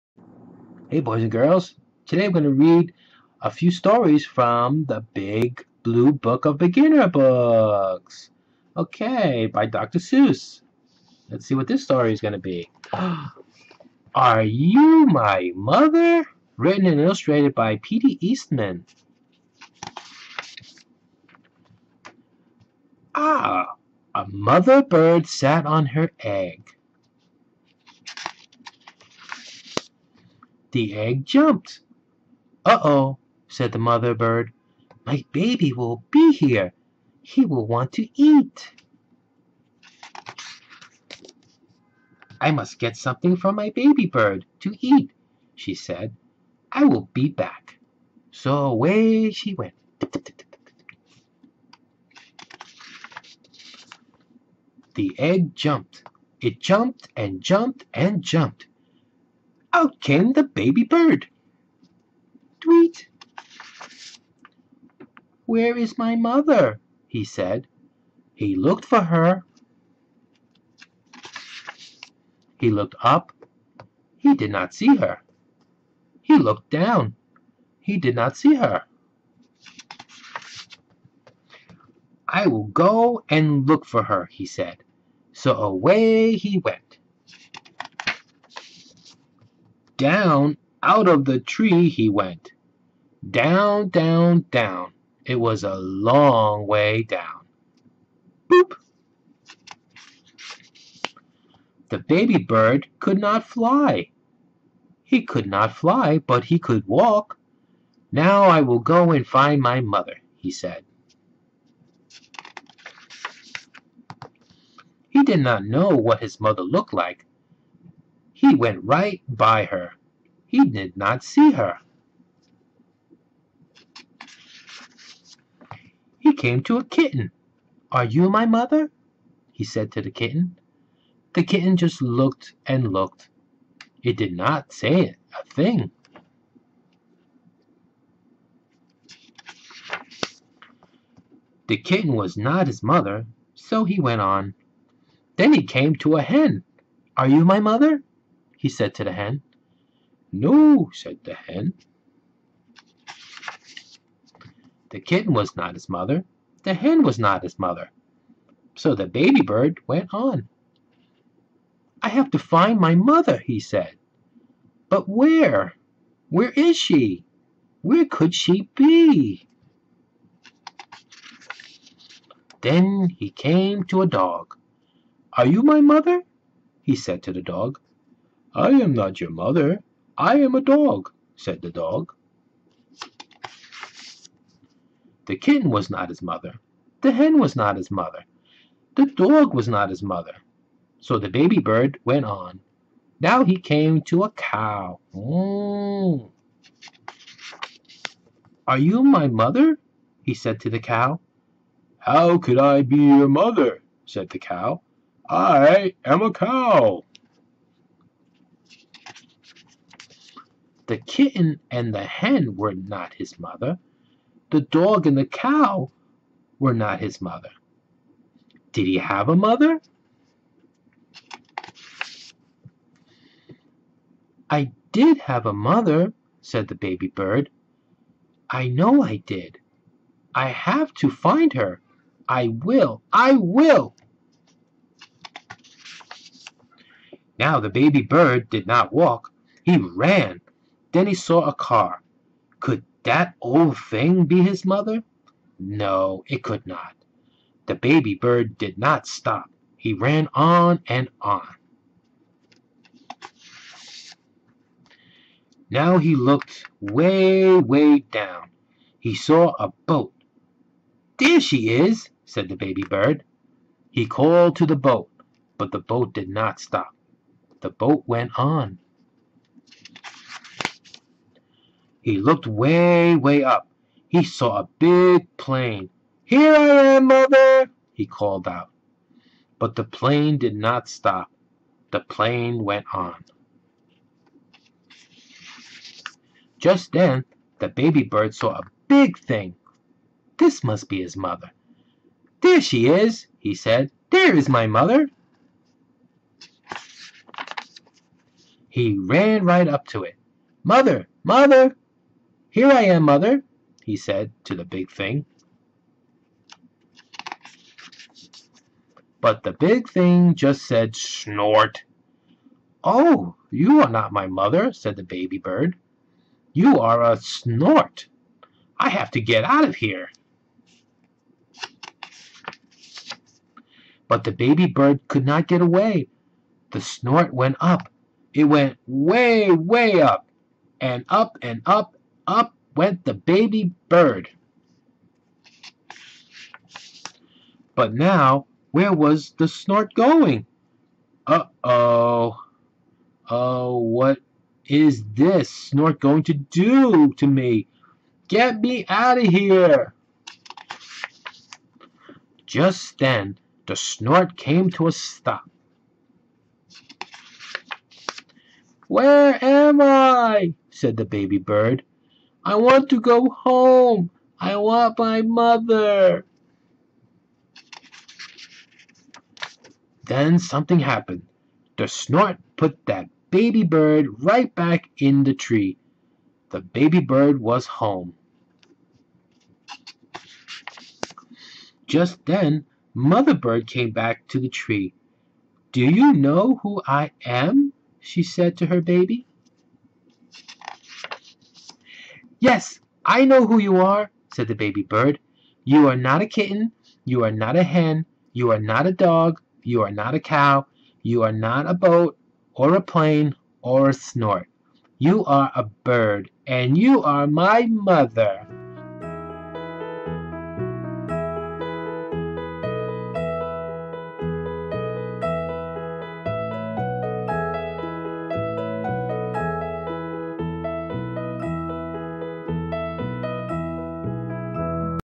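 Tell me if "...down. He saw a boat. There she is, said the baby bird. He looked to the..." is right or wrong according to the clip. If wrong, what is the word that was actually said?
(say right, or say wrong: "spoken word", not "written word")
wrong: "called", not "looked".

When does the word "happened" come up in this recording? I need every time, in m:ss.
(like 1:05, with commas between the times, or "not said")
6:10.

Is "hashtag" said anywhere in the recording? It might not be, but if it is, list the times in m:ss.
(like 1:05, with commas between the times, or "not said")
not said.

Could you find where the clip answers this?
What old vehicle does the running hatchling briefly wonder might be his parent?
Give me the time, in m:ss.
4:01.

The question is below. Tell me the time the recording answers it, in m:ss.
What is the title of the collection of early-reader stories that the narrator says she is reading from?
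0:05.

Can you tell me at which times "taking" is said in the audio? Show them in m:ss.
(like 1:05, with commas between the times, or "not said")
not said.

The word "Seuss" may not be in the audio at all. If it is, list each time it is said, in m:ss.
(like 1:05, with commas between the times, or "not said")
0:09.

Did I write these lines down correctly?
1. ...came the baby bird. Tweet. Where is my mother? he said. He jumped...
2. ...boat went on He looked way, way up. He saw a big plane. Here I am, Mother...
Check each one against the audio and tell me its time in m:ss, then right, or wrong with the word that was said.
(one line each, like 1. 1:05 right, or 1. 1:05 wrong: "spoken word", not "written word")
1. 1:00 wrong: "looked", not "jumped"
2. 4:27 right.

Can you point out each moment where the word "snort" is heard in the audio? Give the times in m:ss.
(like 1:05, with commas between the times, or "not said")
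5:10, 5:17, 5:26, 5:39, 5:45, 5:53, 6:11, 6:43.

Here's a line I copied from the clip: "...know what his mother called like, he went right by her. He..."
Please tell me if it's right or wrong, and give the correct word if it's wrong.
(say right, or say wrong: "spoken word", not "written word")
wrong: "looked", not "called".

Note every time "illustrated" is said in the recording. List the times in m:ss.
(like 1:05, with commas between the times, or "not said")
0:16.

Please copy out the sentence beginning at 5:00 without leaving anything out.
Mother, mother, here I am, Mother, he said to the big thing.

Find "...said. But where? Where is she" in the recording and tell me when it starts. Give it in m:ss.
2:43.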